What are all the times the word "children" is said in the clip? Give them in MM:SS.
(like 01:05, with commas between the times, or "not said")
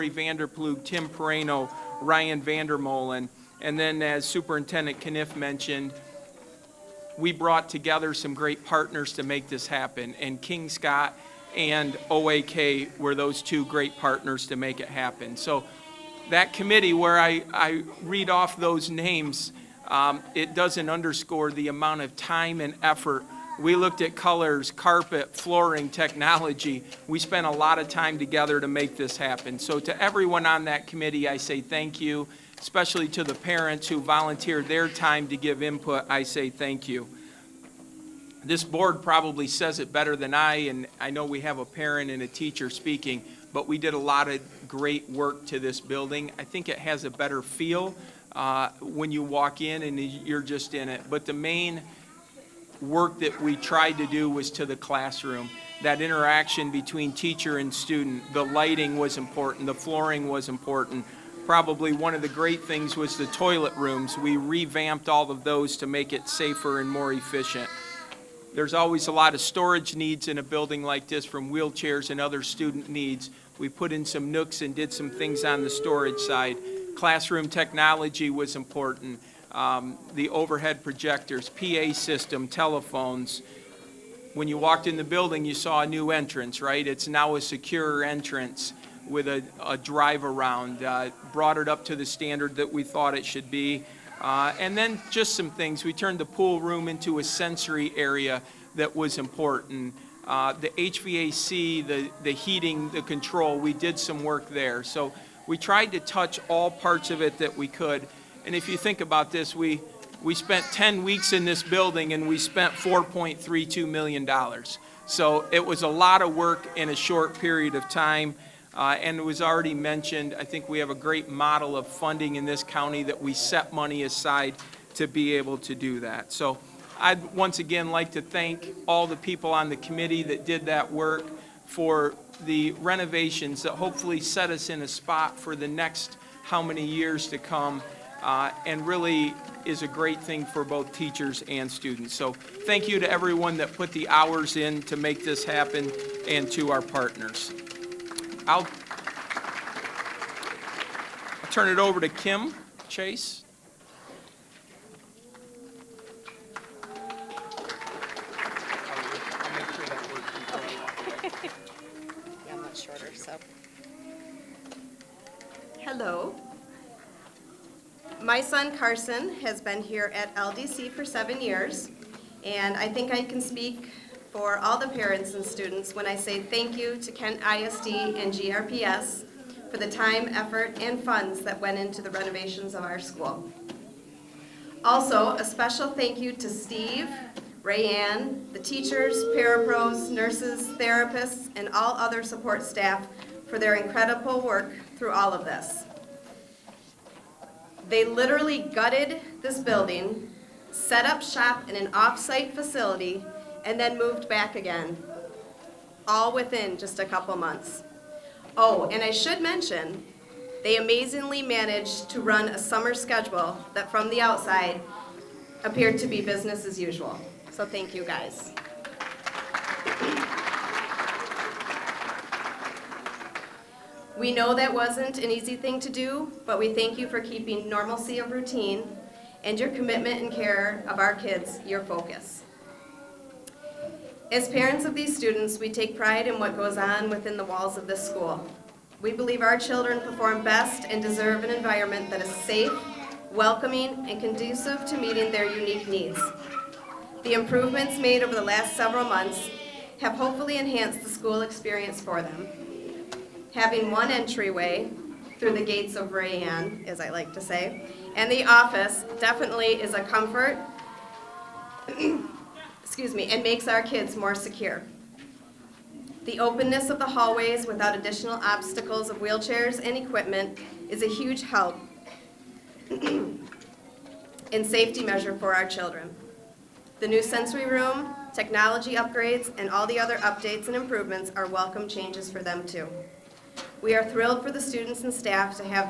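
03:59, 04:35.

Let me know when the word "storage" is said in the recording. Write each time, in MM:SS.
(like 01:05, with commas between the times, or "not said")
01:09, 01:15.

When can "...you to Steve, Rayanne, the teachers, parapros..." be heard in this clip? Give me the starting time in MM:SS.
03:06.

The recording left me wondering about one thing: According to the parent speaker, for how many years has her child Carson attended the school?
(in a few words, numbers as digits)
7.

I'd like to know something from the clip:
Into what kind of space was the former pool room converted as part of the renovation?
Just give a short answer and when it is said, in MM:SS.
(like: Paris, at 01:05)
A sensory area, at 01:37.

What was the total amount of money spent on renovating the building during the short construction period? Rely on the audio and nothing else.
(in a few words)
$4.32 million.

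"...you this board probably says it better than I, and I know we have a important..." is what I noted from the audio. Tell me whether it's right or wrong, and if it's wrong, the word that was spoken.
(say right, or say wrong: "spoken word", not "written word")
wrong: "parent", not "important".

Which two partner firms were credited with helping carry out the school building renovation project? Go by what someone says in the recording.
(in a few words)
Kingscott and OAK.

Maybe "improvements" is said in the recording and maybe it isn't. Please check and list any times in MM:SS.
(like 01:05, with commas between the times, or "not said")
04:07, 04:40.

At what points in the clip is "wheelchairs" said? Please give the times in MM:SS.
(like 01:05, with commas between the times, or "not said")
01:11, 04:29.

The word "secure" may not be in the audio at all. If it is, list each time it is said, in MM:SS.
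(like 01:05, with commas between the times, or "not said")
01:27, 04:24.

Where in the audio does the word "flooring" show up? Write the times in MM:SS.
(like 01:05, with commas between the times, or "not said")
00:25, 00:59.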